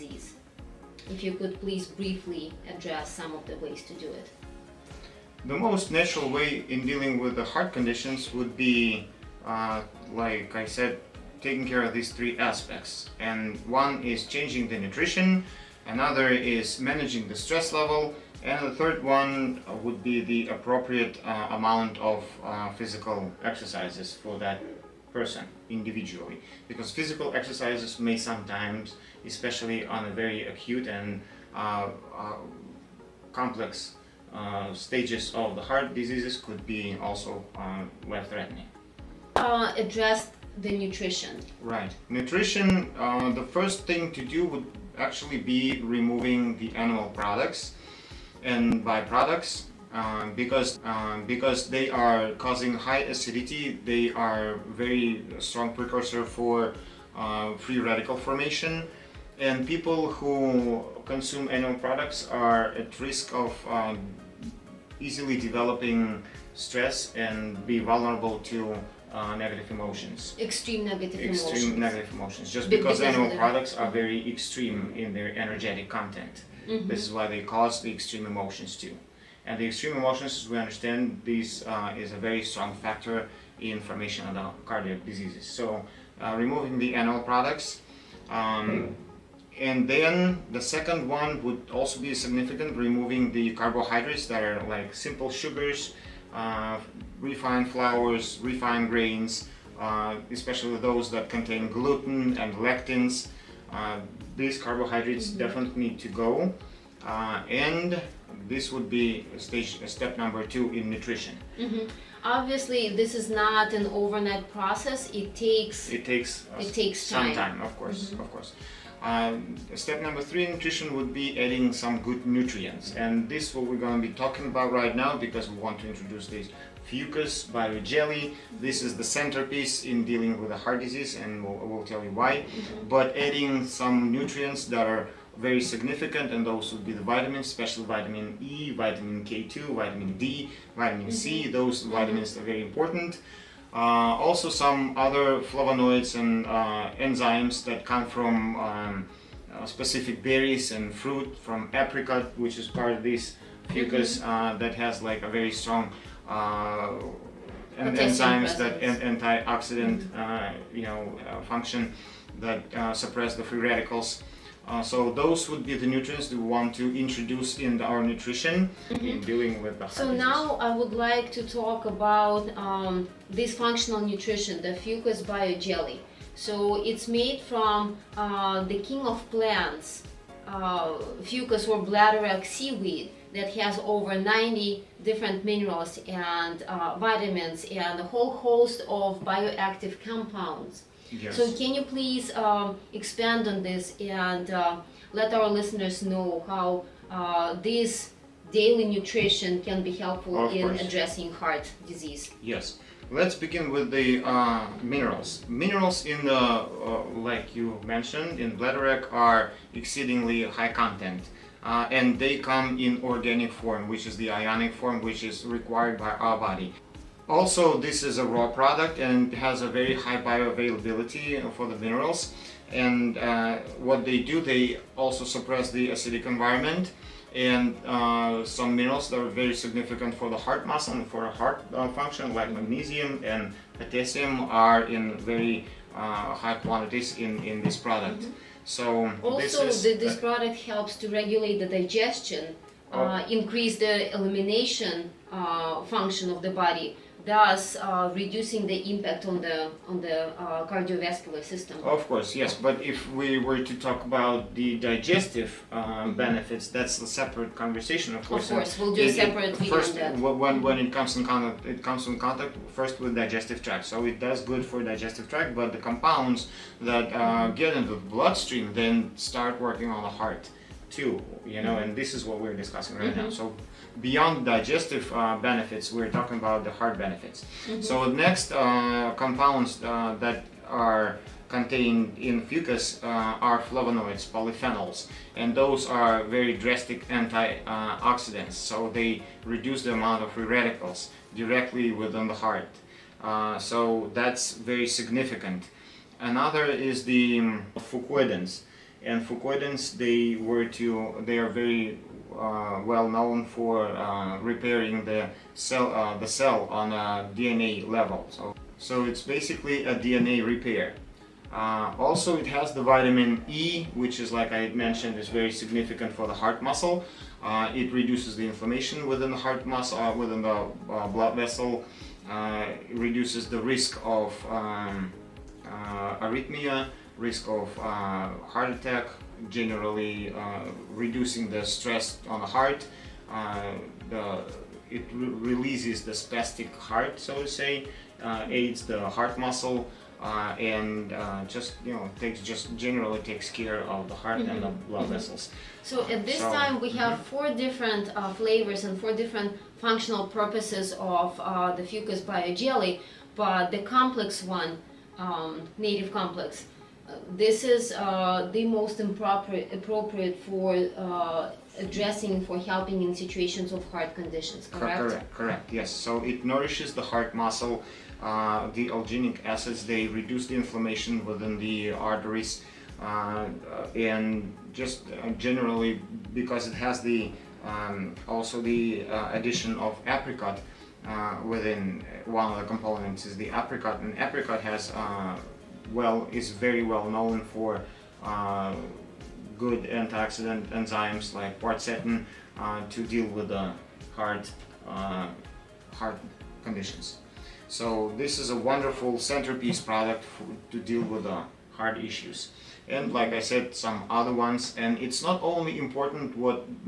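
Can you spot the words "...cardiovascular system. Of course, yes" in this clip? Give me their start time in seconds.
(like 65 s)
250 s.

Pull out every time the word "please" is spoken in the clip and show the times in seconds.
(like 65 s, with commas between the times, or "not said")
1 s, 191 s.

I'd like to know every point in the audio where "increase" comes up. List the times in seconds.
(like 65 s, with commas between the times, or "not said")
243 s.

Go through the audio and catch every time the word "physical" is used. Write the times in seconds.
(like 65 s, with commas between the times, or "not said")
22 s, 26 s.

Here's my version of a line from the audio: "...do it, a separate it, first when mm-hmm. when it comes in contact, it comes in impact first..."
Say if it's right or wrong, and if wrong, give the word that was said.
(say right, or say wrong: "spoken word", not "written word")
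wrong: "contact", not "impact".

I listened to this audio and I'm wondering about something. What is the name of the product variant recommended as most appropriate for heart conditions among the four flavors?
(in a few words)
native complex.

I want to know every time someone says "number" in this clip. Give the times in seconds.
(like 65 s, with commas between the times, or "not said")
110 s, 120 s.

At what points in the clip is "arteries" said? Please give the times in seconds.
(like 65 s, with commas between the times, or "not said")
371 s.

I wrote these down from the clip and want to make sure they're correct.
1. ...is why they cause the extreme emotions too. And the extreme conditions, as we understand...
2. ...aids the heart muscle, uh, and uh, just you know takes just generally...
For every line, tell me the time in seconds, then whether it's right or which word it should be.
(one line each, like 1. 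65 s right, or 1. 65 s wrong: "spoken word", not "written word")
1. 77 s wrong: "emotions", not "conditions"
2. 338 s right.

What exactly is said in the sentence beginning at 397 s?
So this is a wonderful centerpiece product to deal with the hard issues.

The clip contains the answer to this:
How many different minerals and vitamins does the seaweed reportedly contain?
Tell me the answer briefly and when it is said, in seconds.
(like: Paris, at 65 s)
over 90, at 183 s.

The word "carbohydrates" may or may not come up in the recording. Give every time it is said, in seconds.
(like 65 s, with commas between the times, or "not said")
93 s, 104 s.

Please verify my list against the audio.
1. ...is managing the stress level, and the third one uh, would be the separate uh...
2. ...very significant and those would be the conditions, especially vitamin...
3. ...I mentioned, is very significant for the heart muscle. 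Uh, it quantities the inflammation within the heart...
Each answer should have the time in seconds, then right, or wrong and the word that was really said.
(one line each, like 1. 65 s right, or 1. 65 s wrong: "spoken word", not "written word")
1. 16 s wrong: "appropriate", not "separate"
2. 135 s wrong: "vitamins", not "conditions"
3. 314 s wrong: "reduces", not "quantities".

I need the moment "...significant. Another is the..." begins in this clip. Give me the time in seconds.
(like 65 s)
294 s.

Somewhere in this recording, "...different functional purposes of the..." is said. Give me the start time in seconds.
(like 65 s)
349 s.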